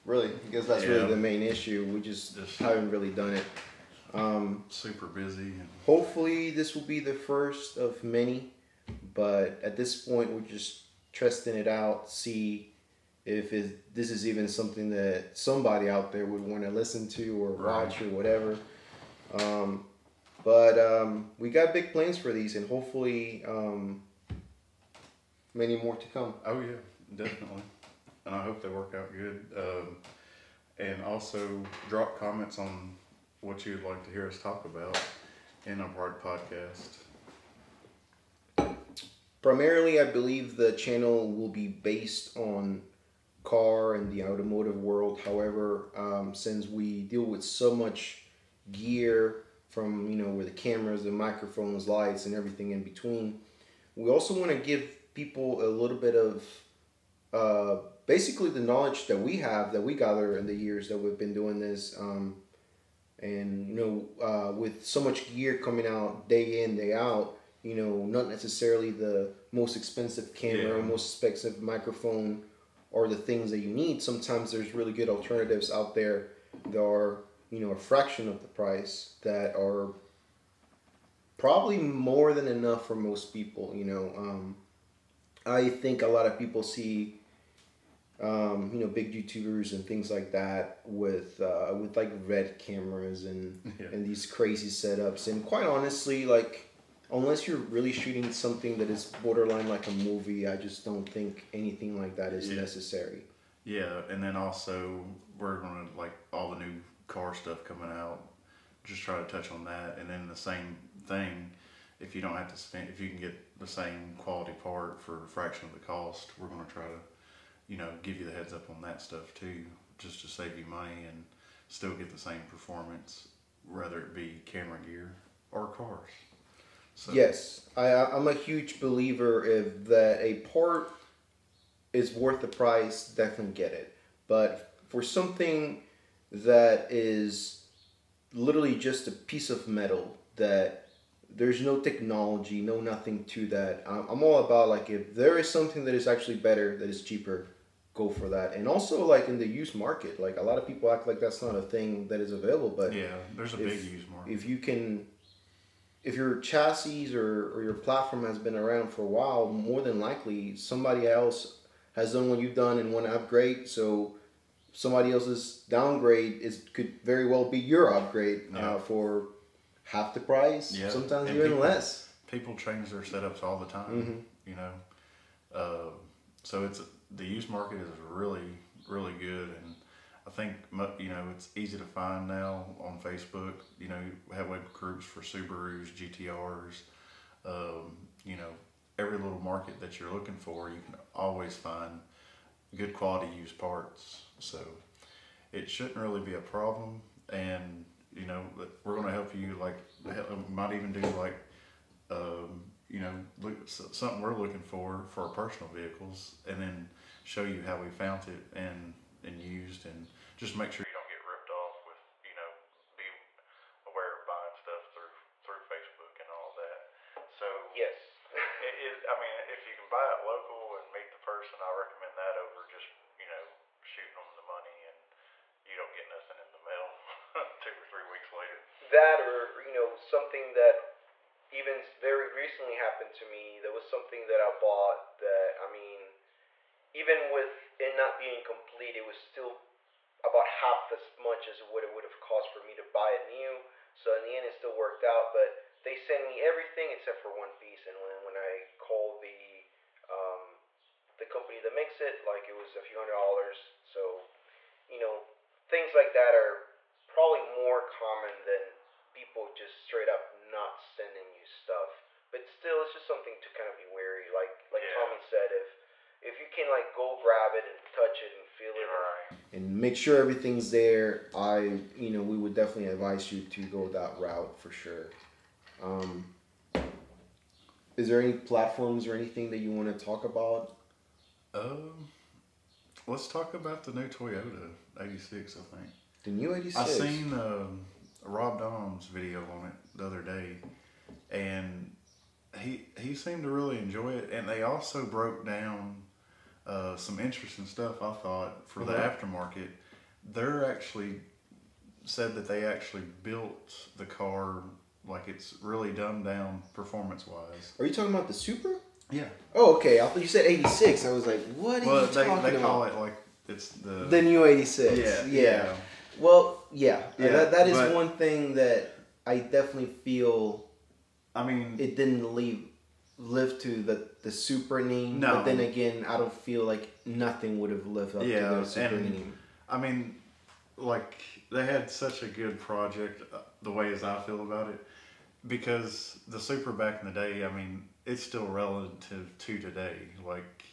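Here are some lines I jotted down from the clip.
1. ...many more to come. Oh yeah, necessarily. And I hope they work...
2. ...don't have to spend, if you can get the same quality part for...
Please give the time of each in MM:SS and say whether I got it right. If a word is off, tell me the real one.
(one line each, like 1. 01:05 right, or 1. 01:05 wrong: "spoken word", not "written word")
1. 00:25 wrong: "definitely", not "necessarily"
2. 01:52 right.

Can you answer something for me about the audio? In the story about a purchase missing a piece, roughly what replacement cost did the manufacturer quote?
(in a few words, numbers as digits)
a few hundred dollars.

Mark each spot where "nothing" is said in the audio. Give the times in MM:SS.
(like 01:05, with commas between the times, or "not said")
02:22, 03:46, 05:27.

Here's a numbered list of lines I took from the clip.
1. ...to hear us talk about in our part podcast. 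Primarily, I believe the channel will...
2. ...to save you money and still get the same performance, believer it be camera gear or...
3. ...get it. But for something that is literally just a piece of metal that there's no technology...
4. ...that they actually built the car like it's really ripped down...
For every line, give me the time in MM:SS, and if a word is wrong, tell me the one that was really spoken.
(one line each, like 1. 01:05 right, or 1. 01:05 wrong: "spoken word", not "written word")
1. 00:34 right
2. 02:00 wrong: "whether", not "believer"
3. 02:13 right
4. 05:02 wrong: "dumbed", not "ripped".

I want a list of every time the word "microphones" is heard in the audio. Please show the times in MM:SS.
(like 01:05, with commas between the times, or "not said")
00:51, 01:11.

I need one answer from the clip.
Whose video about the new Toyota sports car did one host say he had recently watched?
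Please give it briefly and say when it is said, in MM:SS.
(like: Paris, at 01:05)
Rob Dahm, at 04:48.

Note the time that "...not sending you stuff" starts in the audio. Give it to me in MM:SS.
04:20.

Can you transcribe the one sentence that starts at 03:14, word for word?
So it shouldn't really be a problem.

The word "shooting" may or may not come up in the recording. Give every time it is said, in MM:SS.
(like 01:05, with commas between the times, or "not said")
01:37, 03:43.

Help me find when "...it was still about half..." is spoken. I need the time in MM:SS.
03:58.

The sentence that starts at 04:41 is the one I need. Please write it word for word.
Um, let's talk about the new Toyota '86.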